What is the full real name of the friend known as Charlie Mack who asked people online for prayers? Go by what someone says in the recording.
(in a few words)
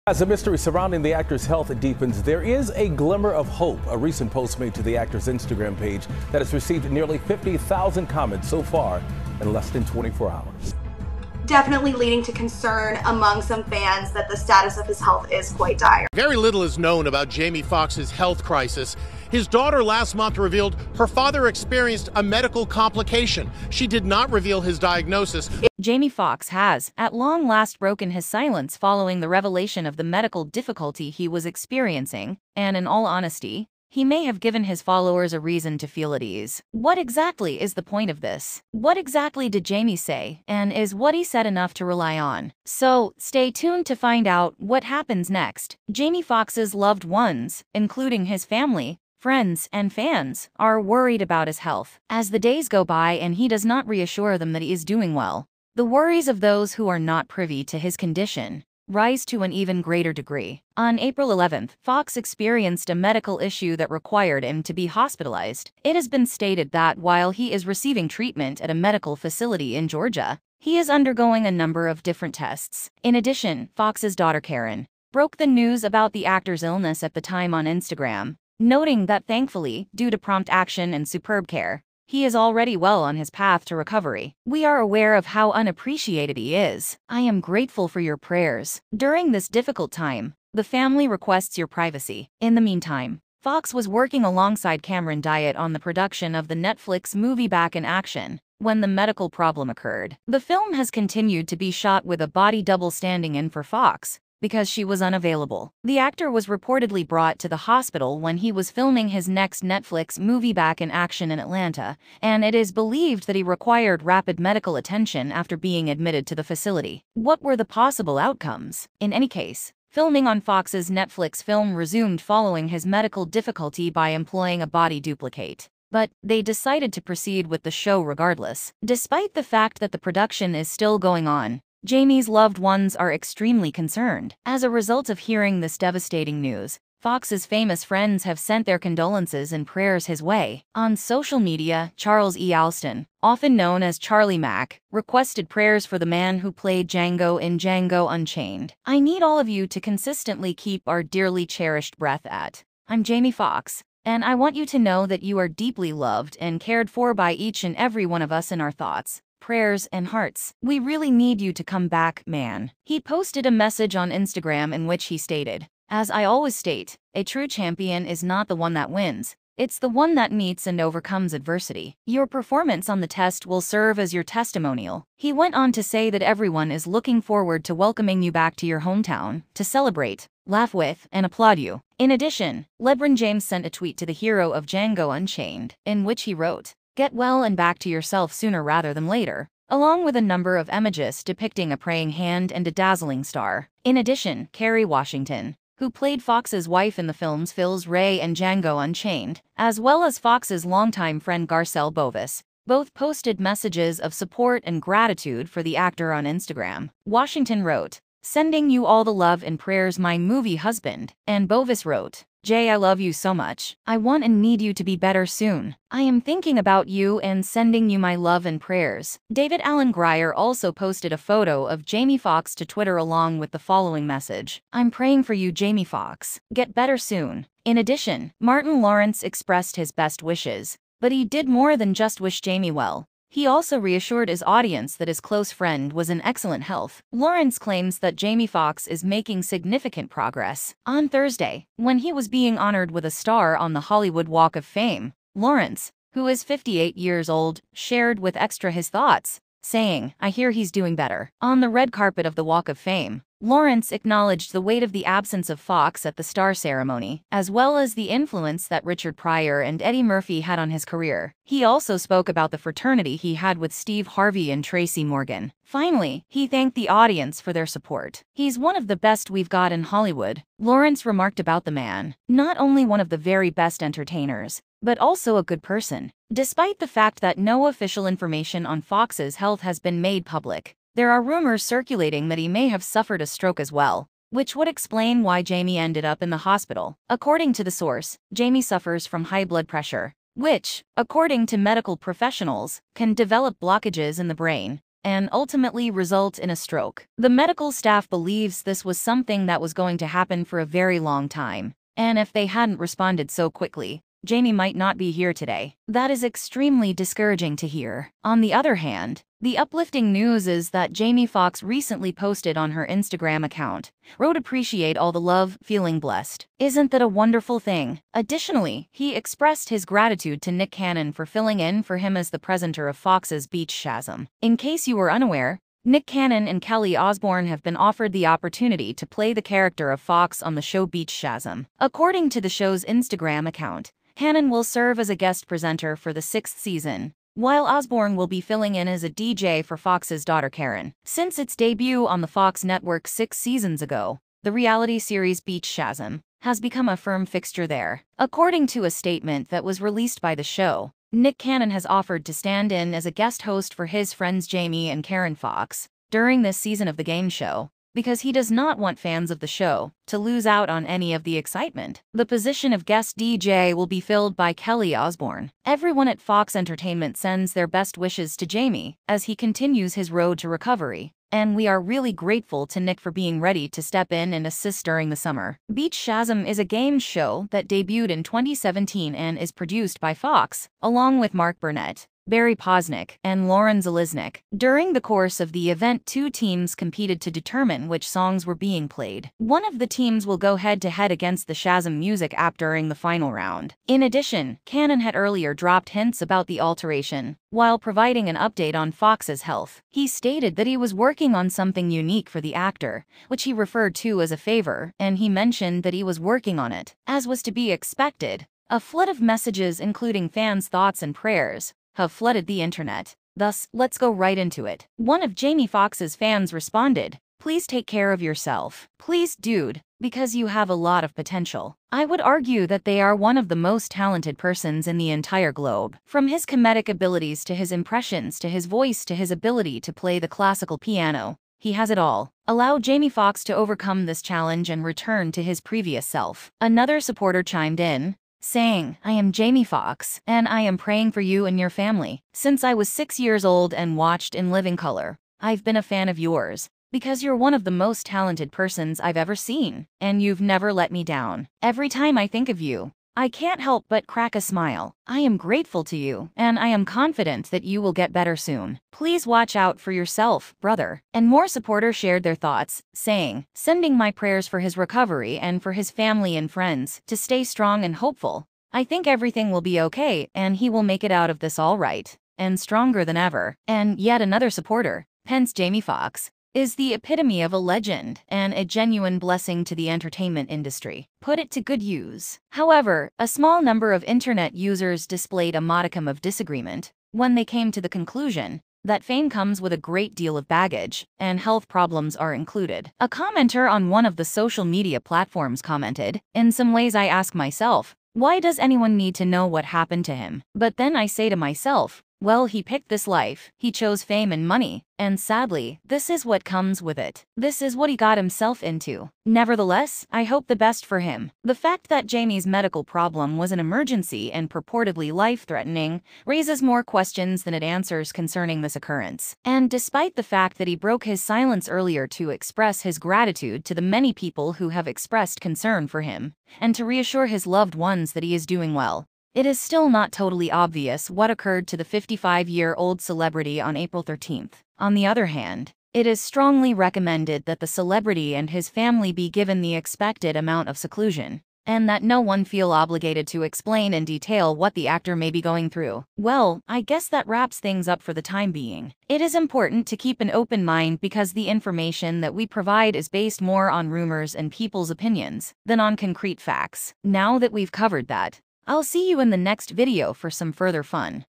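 Charles E. Alston.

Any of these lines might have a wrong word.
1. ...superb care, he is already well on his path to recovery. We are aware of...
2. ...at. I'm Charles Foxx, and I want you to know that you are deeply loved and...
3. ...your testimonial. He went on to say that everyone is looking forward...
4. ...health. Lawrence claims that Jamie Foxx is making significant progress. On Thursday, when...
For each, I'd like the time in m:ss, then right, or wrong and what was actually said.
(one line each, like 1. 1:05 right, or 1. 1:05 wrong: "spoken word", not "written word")
1. 1:21 right
2. 2:32 wrong: "Jamie", not "Charles"
3. 2:54 right
4. 3:56 right.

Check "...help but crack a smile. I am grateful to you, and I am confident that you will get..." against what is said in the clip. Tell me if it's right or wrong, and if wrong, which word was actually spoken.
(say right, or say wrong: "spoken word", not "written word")
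right.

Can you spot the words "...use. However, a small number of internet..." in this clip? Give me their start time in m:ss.
8:01.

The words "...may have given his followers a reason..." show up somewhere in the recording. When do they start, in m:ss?
0:34.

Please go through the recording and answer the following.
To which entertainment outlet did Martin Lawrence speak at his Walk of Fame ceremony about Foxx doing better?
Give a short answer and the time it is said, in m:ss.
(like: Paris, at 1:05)
Extra, at 4:08.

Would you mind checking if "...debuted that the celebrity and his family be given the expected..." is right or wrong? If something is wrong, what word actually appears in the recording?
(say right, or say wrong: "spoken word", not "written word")
wrong: "recommended", not "debuted".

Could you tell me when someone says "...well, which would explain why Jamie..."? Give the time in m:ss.
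4:43.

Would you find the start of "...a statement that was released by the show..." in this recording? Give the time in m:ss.
5:48.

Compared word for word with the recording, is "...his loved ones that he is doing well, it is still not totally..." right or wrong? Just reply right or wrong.
right.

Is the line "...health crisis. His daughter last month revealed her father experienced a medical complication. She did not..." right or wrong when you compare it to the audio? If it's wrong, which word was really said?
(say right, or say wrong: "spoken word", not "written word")
right.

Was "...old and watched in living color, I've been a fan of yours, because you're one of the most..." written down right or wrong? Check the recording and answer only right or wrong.
right.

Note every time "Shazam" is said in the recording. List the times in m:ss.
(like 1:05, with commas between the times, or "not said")
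5:23, 5:31, 5:45, 6:15, 6:31.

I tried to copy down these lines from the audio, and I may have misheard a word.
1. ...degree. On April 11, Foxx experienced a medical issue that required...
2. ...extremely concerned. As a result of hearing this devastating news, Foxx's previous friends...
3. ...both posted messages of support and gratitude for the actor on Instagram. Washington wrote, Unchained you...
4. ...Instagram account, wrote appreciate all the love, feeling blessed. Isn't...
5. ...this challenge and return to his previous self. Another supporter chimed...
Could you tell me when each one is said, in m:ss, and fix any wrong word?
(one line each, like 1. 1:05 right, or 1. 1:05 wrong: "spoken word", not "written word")
1. 1:00 right
2. 2:13 wrong: "famous", not "previous"
3. 3:22 wrong: "Sending", not "Unchained"
4. 5:12 right
5. 7:14 right.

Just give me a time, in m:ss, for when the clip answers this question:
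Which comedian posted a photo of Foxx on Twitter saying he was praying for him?
3:39.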